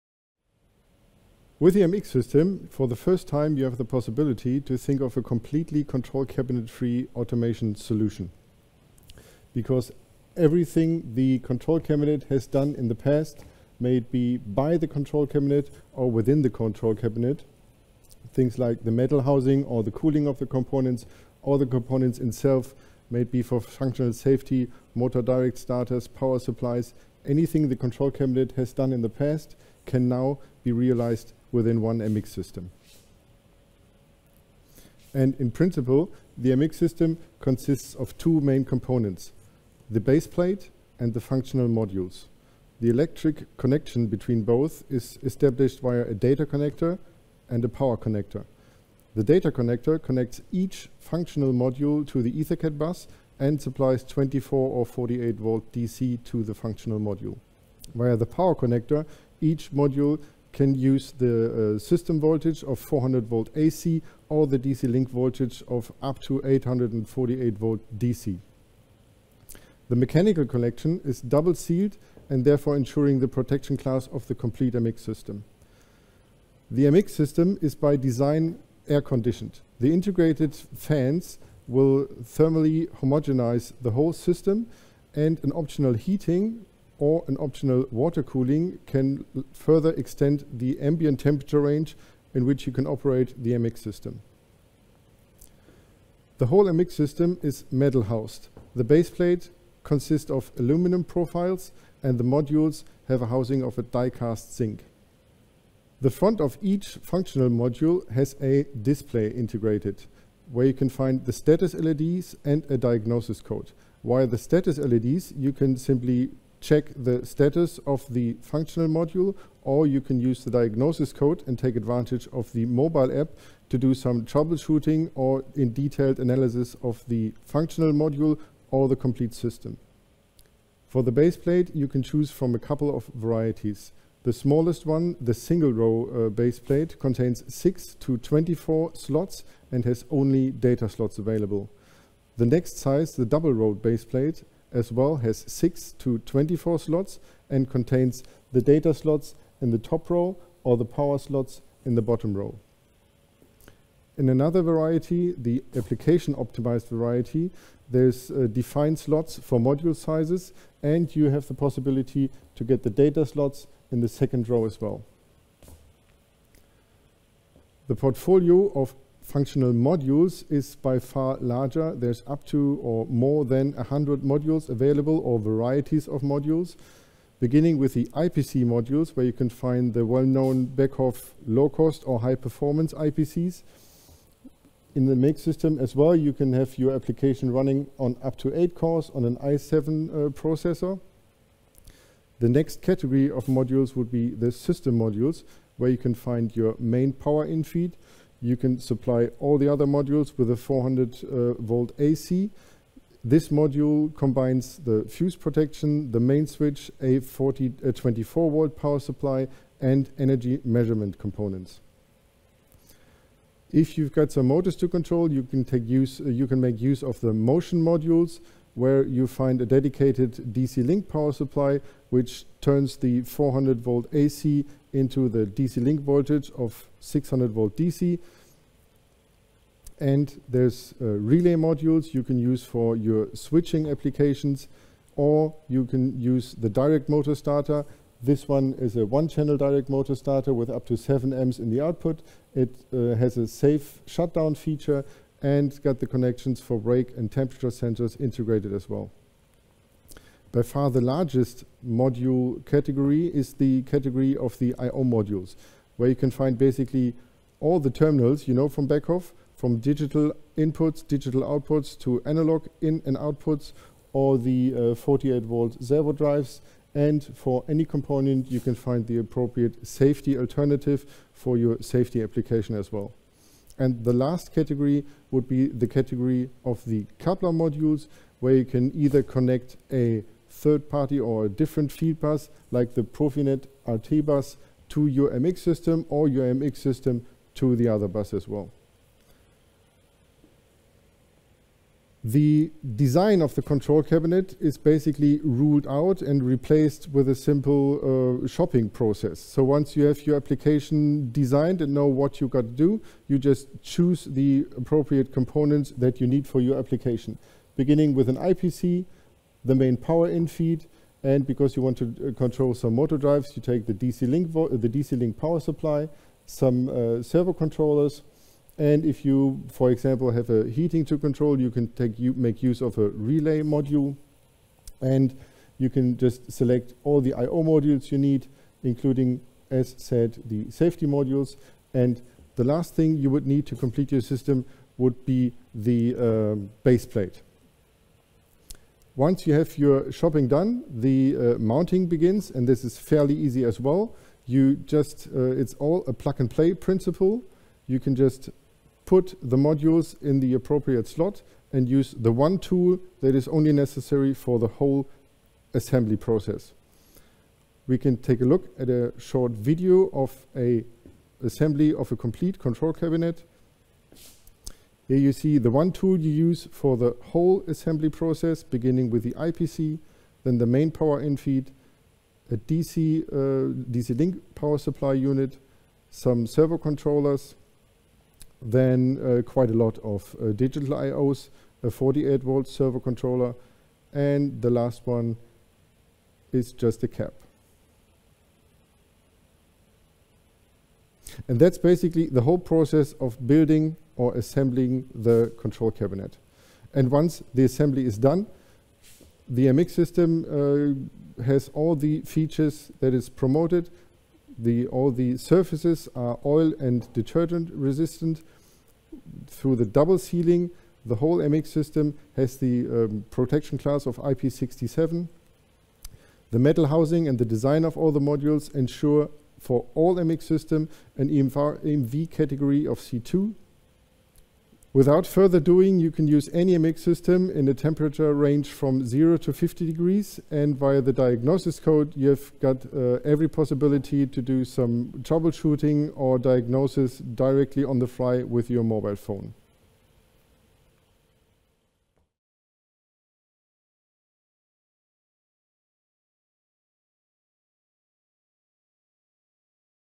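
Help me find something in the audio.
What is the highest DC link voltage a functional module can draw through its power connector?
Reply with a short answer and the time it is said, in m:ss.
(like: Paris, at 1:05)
848 volt DC, at 1:06.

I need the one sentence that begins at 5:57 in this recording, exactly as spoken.
We can take a look at a short video of a assembly of a complete control cabinet.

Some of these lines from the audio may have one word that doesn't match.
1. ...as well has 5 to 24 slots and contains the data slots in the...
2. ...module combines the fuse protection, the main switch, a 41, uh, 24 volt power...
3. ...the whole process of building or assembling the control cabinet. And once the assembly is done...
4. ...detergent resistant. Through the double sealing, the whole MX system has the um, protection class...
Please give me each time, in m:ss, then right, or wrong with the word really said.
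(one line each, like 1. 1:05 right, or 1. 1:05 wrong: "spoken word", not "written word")
1. 2:24 wrong: "6", not "5"
2. 3:23 wrong: "40", not "41"
3. 6:32 right
4. 6:47 right.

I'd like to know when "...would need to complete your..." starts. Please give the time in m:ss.
5:33.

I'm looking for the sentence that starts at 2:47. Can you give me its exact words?
The portfolio of functional modules is by far larger.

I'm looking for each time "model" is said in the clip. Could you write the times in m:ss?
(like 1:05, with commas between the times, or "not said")
not said.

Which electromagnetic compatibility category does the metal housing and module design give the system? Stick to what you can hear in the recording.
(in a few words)
C2.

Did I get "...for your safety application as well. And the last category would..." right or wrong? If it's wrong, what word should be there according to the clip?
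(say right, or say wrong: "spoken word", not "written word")
right.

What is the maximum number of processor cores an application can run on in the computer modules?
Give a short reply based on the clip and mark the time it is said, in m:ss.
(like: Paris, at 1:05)
8, at 3:08.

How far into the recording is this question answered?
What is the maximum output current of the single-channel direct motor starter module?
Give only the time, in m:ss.
4:00.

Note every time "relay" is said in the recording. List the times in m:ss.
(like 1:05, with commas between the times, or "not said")
3:51, 5:23.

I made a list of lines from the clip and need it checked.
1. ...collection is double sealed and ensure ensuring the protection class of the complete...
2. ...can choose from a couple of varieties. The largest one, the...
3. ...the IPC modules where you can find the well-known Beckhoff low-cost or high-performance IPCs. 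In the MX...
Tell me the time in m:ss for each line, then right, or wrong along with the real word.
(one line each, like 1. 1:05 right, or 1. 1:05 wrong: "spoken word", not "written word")
1. 1:10 wrong: "therefore", not "ensure"
2. 2:11 wrong: "smallest", not "largest"
3. 2:57 right.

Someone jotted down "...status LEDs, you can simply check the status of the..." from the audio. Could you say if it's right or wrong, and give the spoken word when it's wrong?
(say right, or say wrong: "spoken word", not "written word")
right.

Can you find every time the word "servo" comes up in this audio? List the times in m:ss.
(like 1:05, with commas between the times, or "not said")
4:25, 5:17, 6:16, 6:22.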